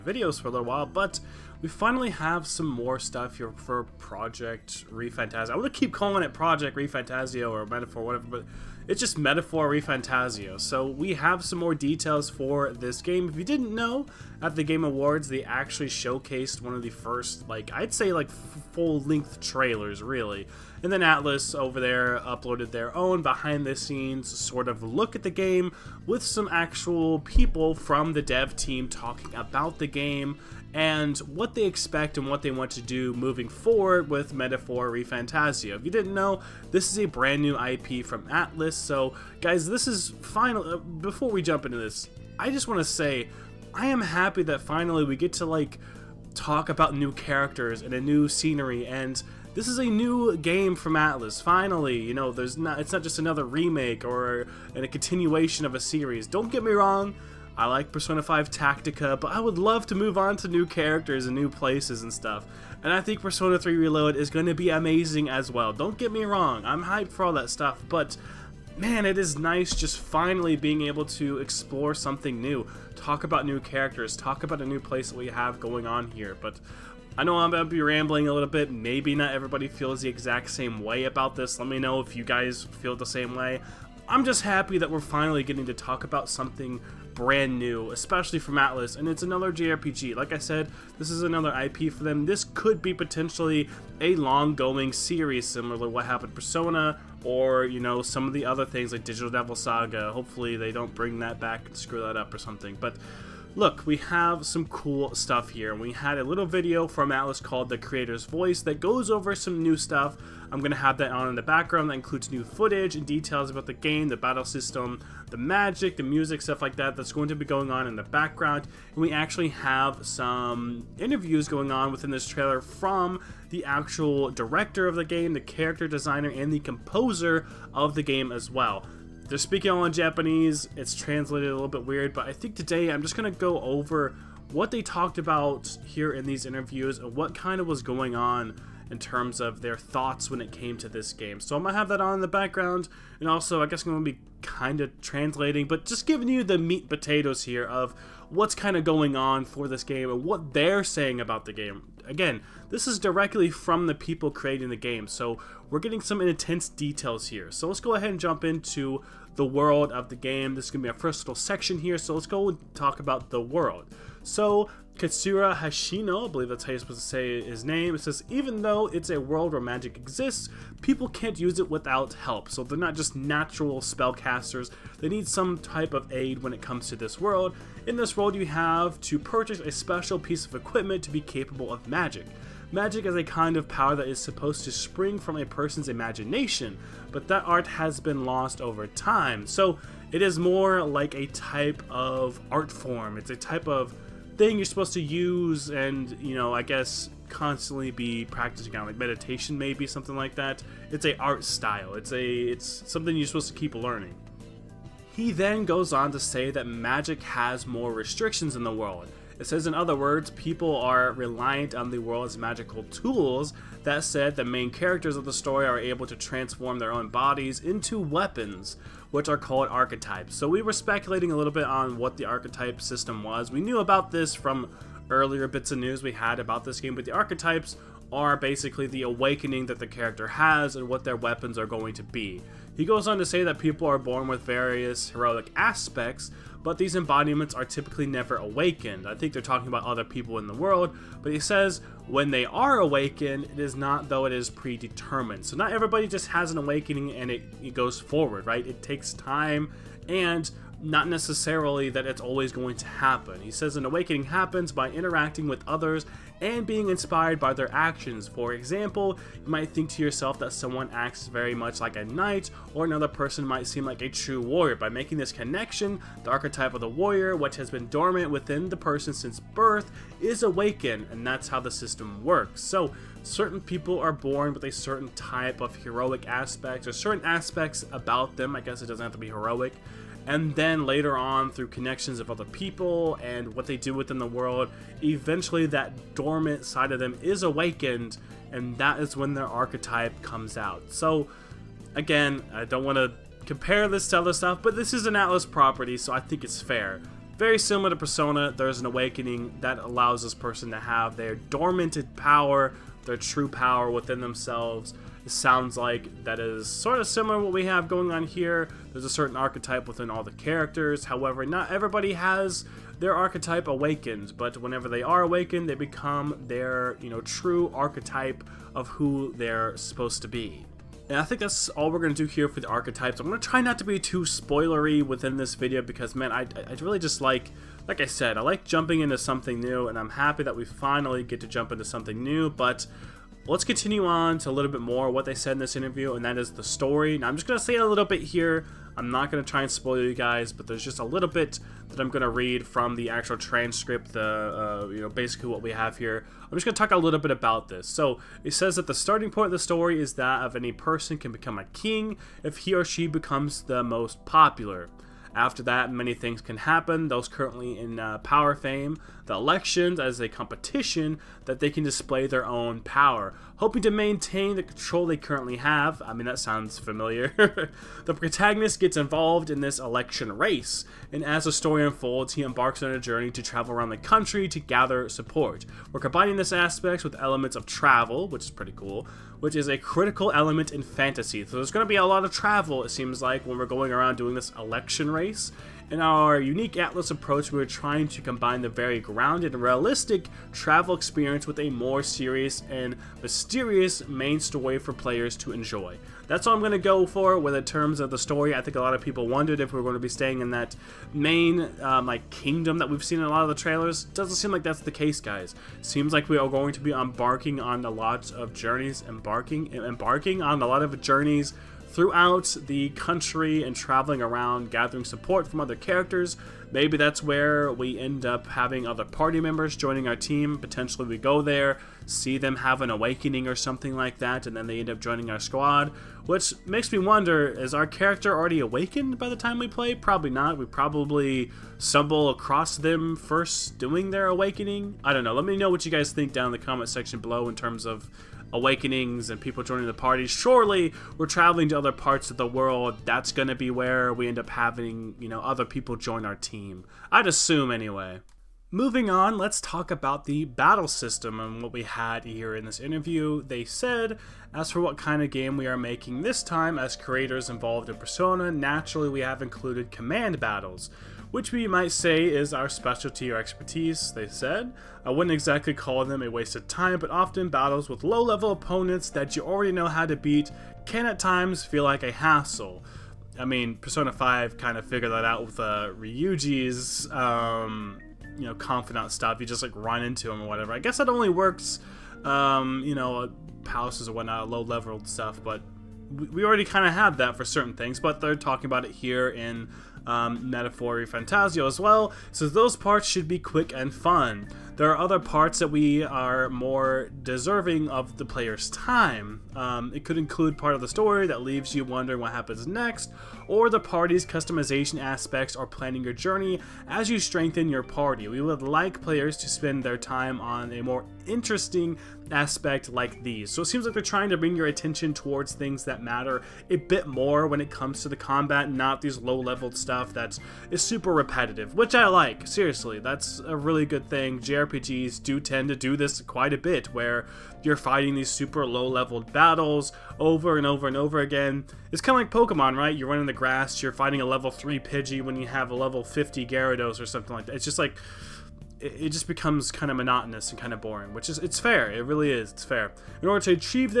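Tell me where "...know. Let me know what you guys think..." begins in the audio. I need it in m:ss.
7:15.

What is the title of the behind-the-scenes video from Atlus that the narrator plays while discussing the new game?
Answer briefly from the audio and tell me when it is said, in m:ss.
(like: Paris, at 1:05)
The Creator's Voice, at 1:47.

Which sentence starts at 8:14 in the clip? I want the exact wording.
There are other parts that we are more deserving of the player's time.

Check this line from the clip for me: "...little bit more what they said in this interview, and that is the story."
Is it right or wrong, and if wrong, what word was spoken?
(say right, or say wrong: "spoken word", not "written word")
right.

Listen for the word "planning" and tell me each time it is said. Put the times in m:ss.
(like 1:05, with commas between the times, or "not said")
8:25.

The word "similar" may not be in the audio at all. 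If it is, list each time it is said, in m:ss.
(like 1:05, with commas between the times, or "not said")
1:35, 4:57, 5:07.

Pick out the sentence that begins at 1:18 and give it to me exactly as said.
Maybe not everybody feels the exact same way about this.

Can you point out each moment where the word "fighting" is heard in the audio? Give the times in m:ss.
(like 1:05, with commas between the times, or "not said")
8:47, 8:53.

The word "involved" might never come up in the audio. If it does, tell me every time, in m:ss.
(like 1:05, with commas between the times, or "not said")
6:08, 7:37.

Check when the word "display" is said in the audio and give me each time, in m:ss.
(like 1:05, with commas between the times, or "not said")
6:01.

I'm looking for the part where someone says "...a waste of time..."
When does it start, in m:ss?
7:46.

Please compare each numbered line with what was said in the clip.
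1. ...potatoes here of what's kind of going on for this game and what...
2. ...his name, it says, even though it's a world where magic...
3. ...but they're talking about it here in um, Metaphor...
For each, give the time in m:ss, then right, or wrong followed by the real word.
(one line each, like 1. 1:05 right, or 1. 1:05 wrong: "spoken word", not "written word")
1. 2:26 right
2. 2:47 right
3. 8:07 right.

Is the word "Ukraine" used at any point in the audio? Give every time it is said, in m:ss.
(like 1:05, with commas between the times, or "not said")
not said.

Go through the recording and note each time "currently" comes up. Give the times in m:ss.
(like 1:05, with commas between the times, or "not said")
5:57, 6:05.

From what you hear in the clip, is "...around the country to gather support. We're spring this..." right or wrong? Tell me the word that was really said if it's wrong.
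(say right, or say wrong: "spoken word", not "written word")
wrong: "combining", not "spring".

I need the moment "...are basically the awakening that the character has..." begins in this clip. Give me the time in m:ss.
3:48.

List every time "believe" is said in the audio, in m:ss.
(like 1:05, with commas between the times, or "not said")
2:46.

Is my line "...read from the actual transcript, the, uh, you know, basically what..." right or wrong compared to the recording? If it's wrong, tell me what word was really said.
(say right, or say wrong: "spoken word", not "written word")
right.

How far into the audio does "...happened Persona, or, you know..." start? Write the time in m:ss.
1:36.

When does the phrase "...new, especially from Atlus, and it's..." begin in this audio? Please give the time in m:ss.
1:27.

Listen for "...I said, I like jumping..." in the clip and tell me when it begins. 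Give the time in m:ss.
5:28.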